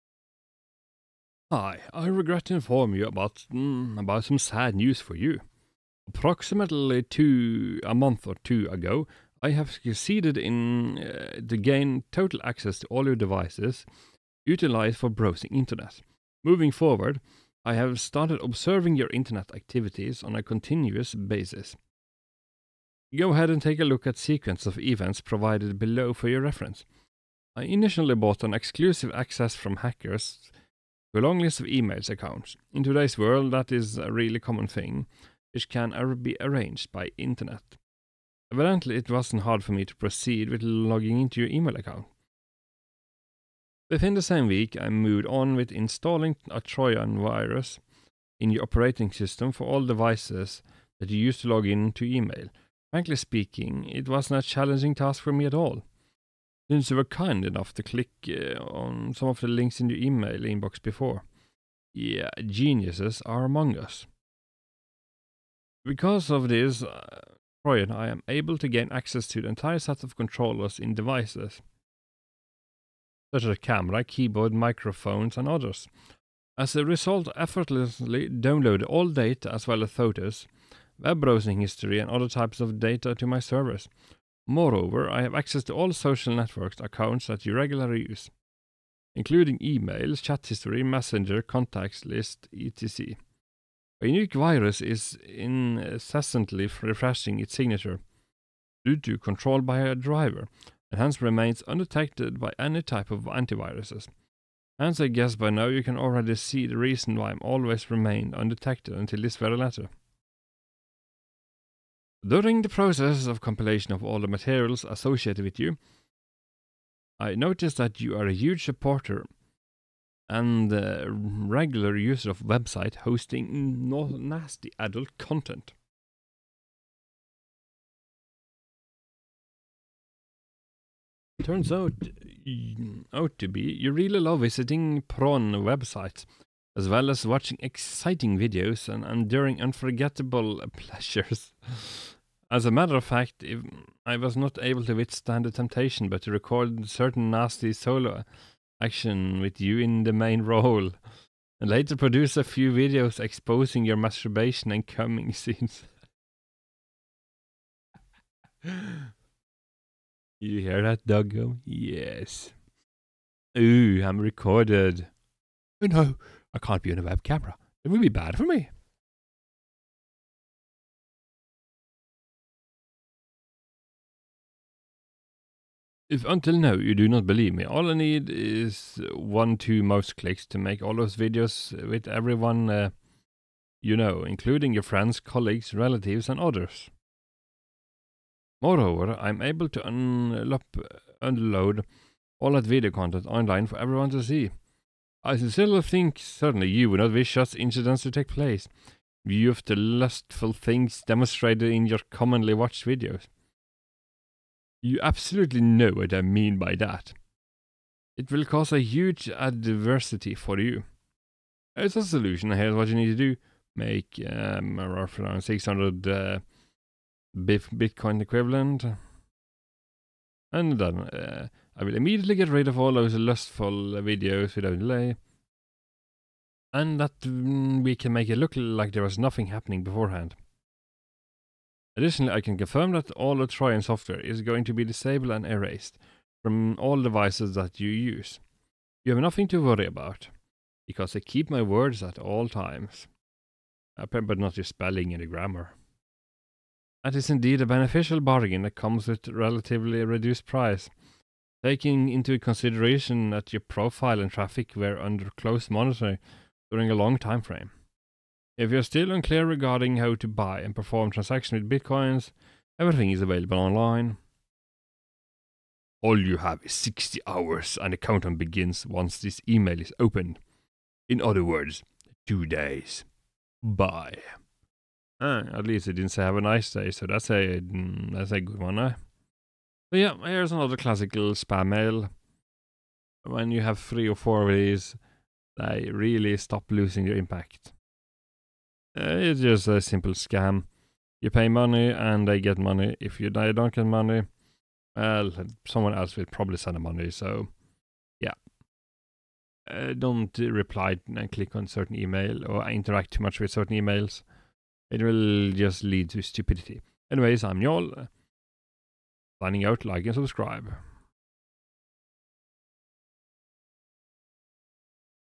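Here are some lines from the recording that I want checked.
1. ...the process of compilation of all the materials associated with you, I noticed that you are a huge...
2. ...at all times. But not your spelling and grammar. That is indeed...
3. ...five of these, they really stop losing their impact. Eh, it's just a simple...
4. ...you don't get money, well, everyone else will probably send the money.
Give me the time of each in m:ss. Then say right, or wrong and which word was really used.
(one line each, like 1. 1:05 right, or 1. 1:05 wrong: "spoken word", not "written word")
1. 1:52 right
2. 4:02 right
3. 4:44 wrong: "four", not "five"
4. 4:53 wrong: "someone", not "everyone".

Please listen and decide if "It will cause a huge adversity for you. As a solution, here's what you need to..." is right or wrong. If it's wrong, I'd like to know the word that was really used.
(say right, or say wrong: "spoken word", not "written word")
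right.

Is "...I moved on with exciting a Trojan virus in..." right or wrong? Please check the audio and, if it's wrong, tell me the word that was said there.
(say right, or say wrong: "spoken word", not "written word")
wrong: "installing", not "exciting".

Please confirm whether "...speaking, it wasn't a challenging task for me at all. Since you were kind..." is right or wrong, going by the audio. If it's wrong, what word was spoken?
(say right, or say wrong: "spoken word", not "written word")
right.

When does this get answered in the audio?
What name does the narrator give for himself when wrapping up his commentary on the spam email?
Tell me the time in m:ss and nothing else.
5:07.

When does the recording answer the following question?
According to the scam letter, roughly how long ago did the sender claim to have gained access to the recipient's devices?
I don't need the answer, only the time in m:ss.
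0:07.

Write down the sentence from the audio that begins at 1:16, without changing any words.
As a result, effortlessly download all data as well as photos, web browsing history, and other types of data to my servers.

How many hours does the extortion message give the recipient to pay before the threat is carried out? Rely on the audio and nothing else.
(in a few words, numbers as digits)
60.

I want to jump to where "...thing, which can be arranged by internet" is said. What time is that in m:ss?
0:34.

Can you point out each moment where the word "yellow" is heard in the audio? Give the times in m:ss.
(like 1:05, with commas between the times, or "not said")
not said.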